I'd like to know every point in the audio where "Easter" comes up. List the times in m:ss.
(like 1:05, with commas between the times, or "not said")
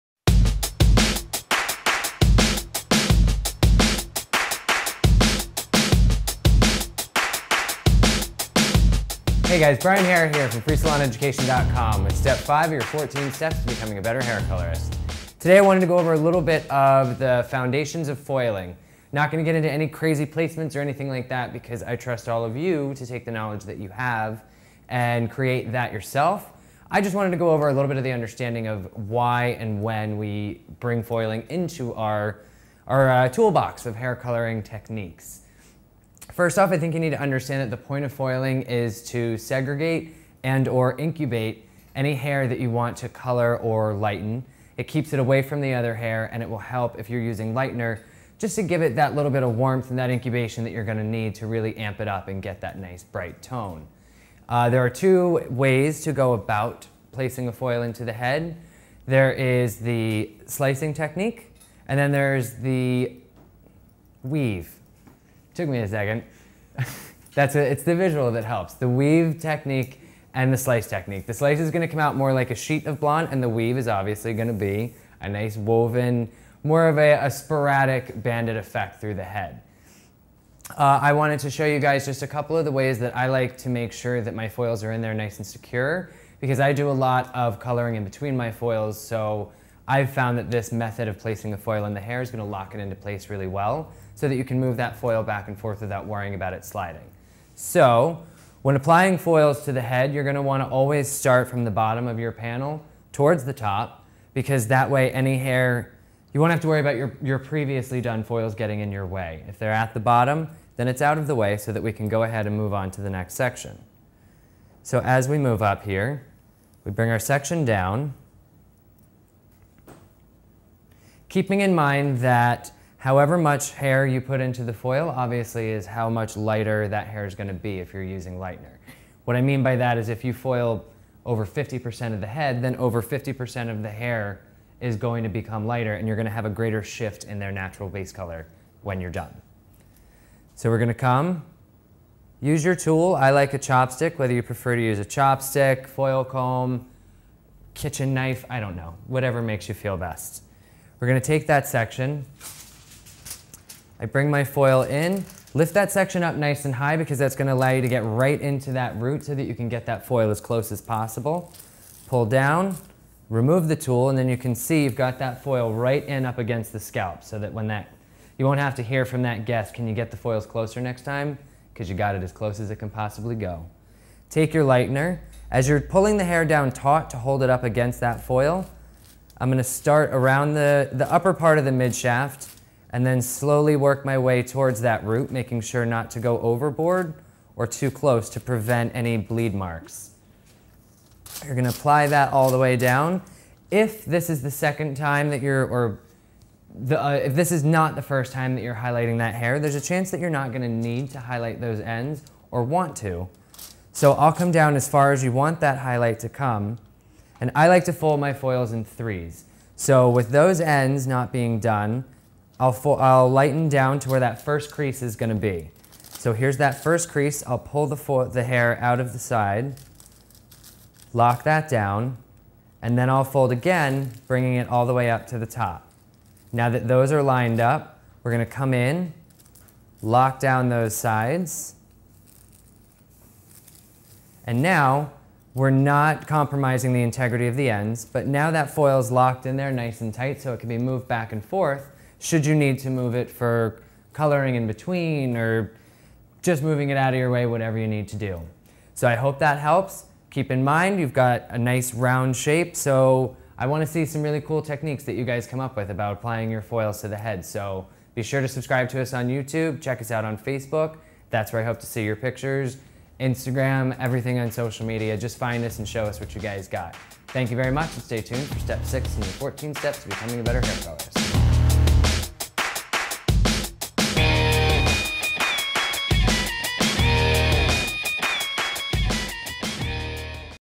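not said.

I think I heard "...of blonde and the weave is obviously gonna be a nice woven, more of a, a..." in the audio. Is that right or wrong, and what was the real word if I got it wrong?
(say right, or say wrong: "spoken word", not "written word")
right.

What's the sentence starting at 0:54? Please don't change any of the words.
Uh, there are two ways to go about placing a foil into the head.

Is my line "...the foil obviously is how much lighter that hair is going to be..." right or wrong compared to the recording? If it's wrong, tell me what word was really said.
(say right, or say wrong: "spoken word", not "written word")
right.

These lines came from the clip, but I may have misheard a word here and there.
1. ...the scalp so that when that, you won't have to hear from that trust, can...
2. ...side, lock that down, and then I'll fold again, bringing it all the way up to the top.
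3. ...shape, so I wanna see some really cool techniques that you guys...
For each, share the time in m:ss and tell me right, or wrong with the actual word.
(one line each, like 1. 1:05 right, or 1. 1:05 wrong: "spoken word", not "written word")
1. 2:46 wrong: "guest", not "trust"
2. 3:39 right
3. 4:12 right.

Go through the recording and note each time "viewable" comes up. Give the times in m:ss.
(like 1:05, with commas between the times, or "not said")
not said.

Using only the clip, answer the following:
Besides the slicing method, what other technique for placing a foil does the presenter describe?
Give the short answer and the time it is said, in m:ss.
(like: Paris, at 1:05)
Weave technique, at 1:08.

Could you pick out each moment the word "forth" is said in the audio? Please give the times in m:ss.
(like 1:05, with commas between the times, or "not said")
1:35, 4:01.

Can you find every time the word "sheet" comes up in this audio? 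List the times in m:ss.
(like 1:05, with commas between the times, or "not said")
1:12.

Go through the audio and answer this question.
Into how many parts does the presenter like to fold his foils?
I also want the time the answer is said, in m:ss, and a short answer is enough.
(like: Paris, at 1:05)
3, at 3:28.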